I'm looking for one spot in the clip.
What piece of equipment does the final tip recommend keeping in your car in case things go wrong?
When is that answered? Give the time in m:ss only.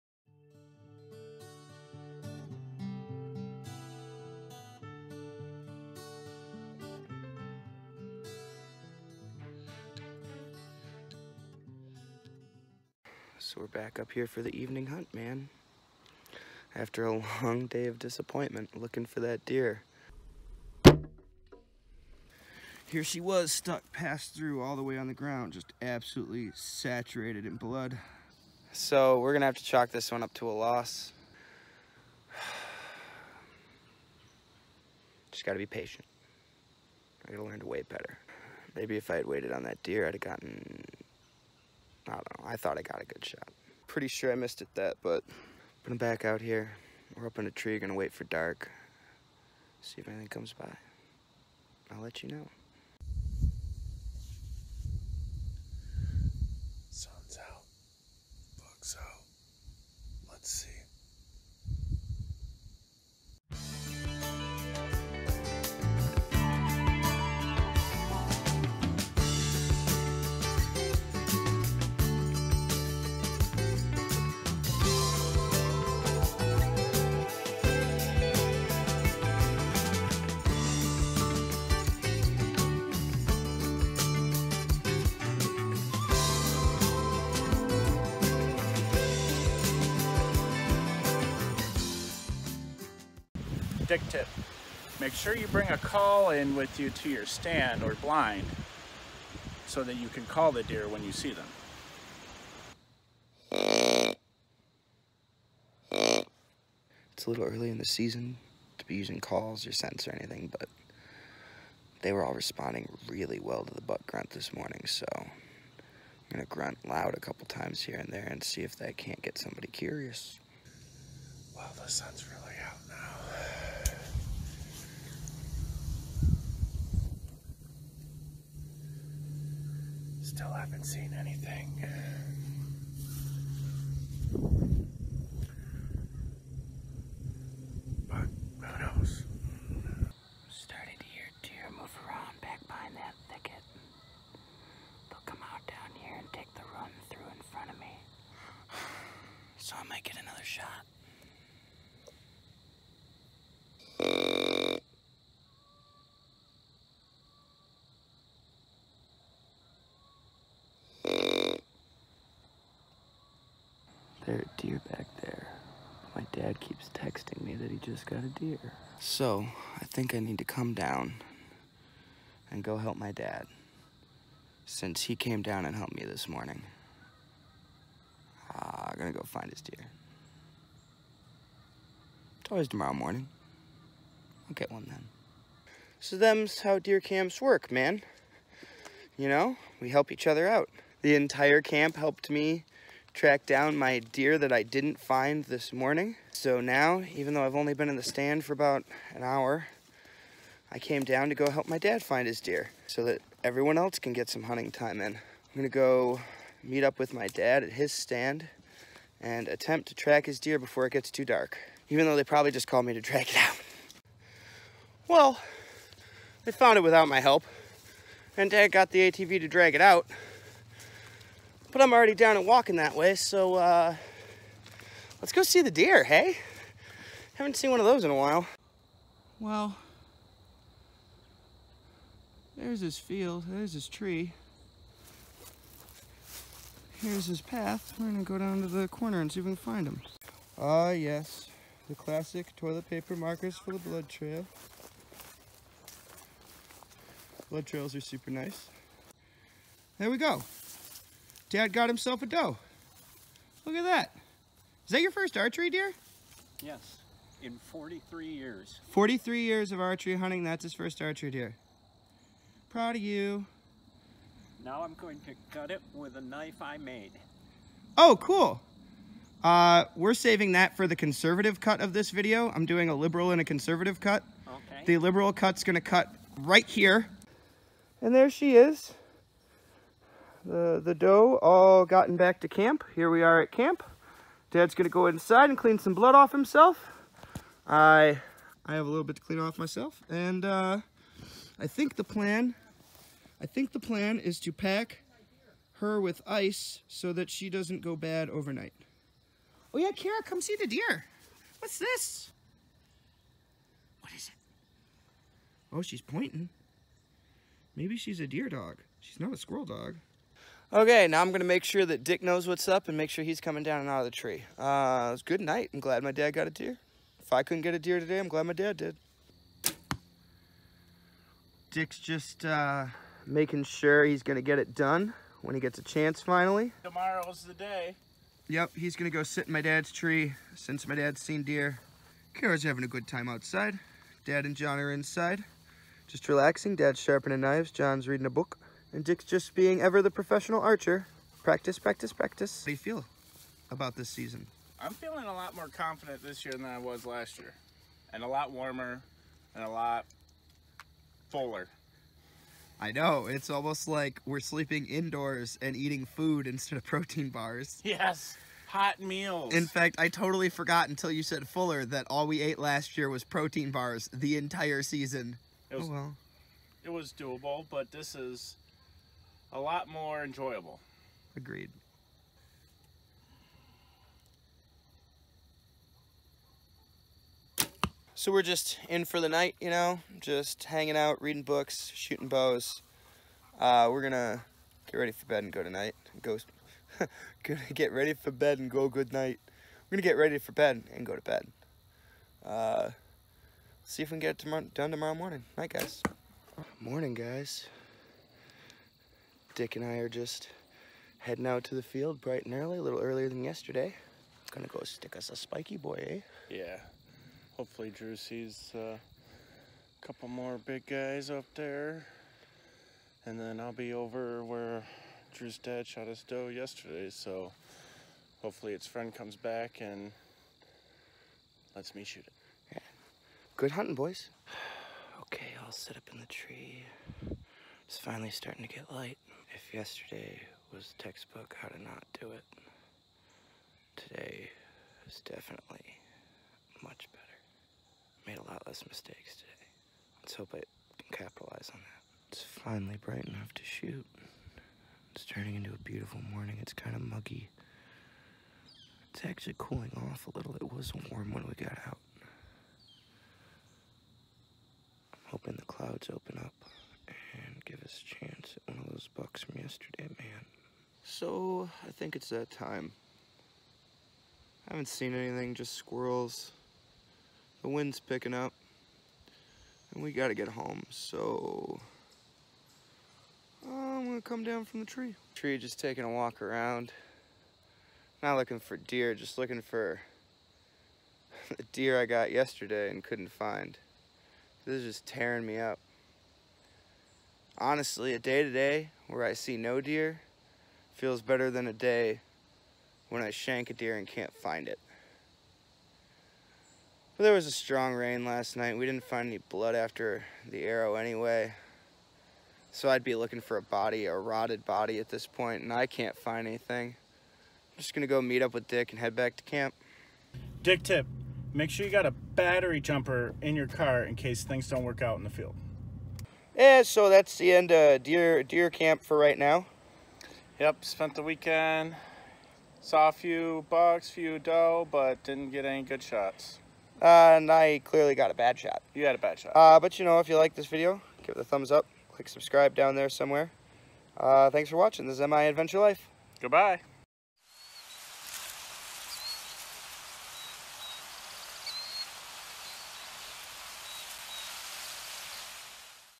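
8:32.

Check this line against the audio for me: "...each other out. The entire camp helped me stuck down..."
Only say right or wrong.
wrong.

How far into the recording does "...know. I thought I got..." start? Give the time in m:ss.
0:42.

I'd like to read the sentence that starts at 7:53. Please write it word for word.
I'm gonna come down from the tree.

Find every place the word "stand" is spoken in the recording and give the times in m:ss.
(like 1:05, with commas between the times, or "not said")
1:37, 3:18, 3:27.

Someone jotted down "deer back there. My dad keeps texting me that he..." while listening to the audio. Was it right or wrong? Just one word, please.
right.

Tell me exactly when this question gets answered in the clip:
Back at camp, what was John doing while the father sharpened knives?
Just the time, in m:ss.
5:38.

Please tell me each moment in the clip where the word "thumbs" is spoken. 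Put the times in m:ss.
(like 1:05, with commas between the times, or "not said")
8:51.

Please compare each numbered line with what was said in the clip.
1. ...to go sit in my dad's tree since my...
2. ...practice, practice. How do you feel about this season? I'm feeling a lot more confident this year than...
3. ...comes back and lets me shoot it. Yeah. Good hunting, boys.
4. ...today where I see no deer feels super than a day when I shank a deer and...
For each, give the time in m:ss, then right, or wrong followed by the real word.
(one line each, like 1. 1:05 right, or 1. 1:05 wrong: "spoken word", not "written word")
1. 5:29 right
2. 5:41 right
3. 6:59 right
4. 8:08 wrong: "better", not "super".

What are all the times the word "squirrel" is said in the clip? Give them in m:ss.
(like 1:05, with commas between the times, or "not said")
5:09, 7:45.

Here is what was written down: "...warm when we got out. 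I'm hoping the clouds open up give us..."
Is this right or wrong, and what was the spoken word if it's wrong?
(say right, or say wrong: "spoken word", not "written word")
right.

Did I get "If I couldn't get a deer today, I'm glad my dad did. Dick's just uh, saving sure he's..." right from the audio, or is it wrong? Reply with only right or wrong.
wrong.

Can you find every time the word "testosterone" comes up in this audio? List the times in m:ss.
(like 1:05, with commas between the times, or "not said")
not said.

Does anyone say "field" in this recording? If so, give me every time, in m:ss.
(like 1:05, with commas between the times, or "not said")
3:52, 6:41, 8:35.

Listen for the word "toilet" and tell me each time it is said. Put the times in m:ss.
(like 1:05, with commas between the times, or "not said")
4:02.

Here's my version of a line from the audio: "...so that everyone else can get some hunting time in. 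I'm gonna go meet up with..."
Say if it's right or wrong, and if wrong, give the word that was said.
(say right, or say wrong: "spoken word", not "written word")
right.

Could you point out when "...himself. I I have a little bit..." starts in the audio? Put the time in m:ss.
4:46.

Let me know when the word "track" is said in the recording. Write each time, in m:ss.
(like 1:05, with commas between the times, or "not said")
3:13, 3:29.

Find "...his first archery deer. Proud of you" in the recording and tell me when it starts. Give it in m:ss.
4:20.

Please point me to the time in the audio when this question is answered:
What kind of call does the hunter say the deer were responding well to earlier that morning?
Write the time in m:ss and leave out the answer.
1:53.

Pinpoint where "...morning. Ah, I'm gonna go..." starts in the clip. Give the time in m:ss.
2:56.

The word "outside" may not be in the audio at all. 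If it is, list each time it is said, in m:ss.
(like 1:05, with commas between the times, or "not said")
5:33.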